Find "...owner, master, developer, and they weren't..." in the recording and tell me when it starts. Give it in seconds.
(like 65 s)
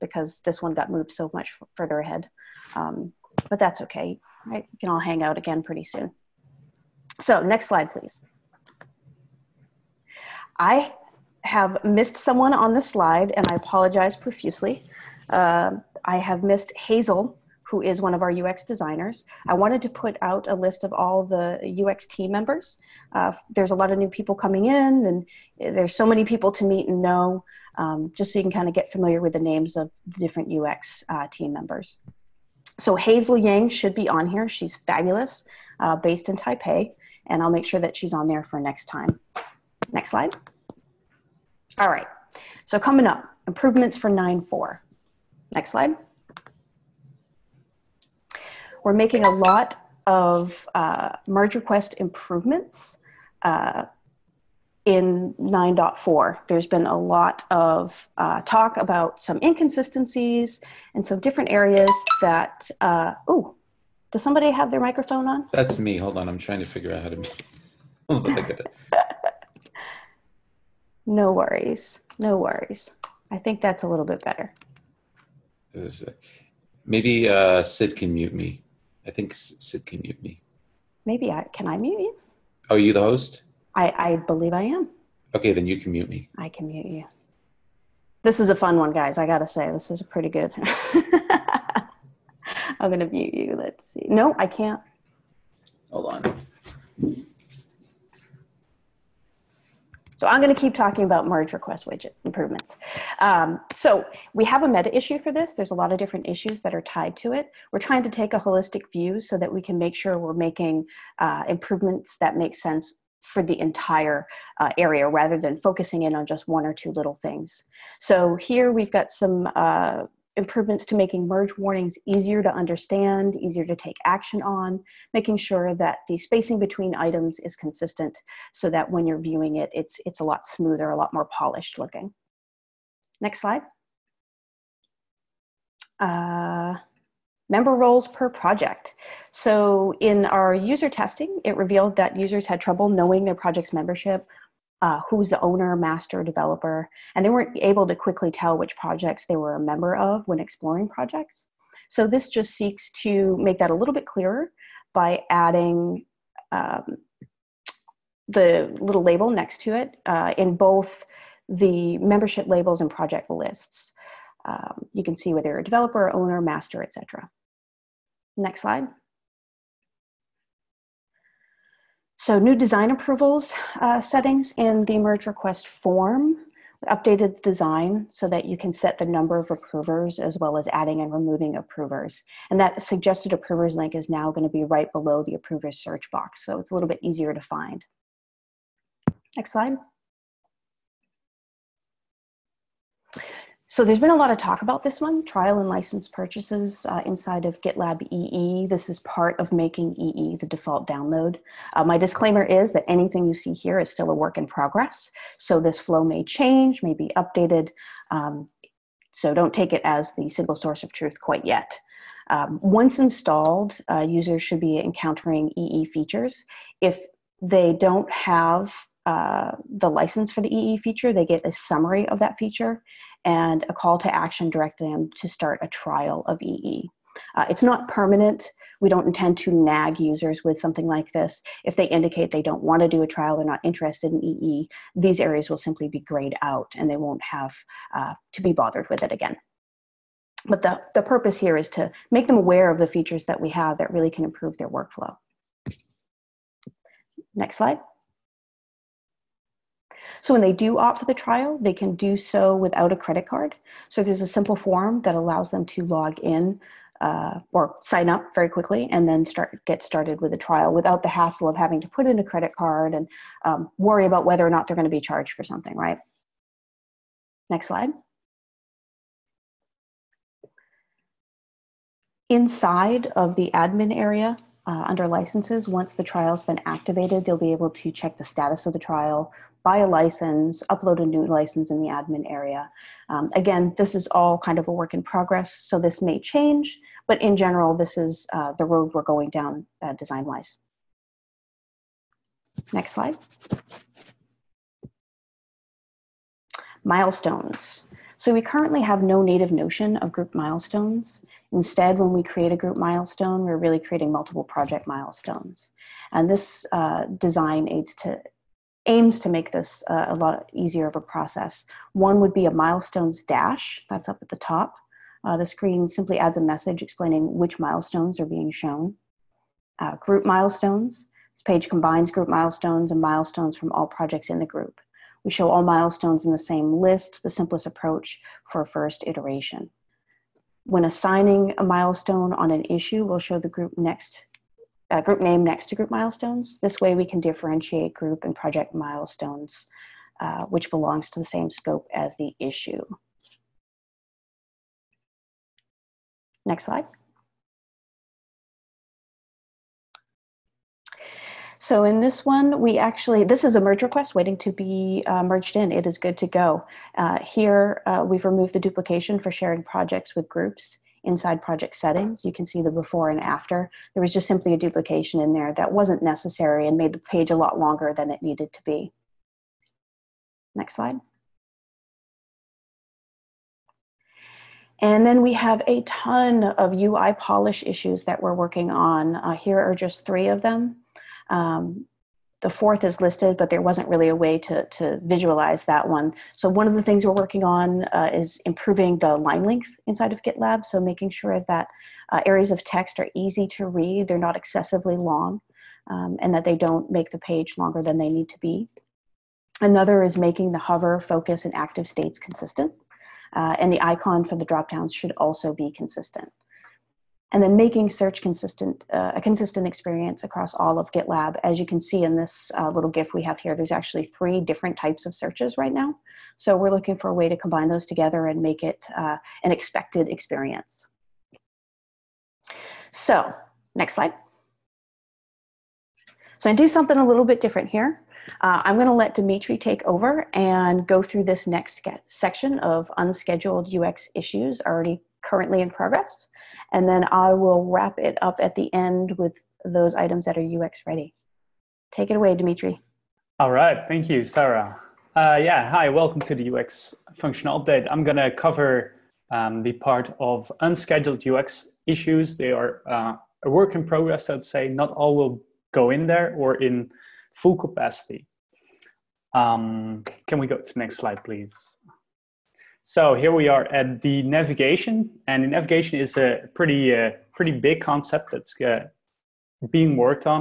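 145 s.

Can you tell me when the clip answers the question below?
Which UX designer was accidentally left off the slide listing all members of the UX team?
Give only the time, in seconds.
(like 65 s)
32 s.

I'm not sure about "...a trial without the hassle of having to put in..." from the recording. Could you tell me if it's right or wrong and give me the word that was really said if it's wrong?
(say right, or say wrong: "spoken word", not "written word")
right.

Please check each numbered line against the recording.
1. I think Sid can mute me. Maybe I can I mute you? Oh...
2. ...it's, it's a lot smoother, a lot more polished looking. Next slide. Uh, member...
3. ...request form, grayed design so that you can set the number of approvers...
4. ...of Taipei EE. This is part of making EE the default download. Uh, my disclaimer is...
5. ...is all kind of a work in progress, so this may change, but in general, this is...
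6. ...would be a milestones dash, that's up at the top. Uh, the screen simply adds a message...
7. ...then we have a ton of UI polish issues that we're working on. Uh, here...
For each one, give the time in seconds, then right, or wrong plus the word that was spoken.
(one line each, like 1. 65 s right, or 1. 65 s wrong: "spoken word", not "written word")
1. 79 s right
2. 129 s right
3. 175 s wrong: "updated", not "grayed"
4. 197 s wrong: "GitLab", not "Taipei"
5. 283 s right
6. 312 s right
7. 375 s right.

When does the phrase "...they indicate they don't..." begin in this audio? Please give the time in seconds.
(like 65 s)
231 s.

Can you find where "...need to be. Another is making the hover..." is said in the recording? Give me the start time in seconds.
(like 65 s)
398 s.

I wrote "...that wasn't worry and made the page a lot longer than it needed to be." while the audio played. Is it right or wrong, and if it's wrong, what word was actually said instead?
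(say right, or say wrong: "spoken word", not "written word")
wrong: "necessary", not "worry".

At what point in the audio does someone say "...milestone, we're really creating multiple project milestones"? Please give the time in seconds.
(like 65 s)
302 s.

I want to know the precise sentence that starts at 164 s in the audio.
Um, you can see whether you're a developer, owner, master, etc.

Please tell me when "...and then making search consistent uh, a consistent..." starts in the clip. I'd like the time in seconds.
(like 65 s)
407 s.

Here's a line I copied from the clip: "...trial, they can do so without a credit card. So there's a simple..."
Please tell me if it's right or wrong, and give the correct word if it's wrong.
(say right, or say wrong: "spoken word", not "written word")
right.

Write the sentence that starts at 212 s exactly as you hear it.
Um, once installed, uh, users should be encountering EE features.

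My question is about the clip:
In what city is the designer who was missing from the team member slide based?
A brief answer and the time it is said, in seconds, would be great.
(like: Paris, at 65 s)
Taipei, at 36 s.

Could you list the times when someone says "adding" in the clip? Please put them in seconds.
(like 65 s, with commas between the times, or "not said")
155 s, 180 s.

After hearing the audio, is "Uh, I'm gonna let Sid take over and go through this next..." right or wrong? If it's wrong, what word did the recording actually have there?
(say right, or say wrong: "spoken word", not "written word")
wrong: "Dimitrie", not "Sid".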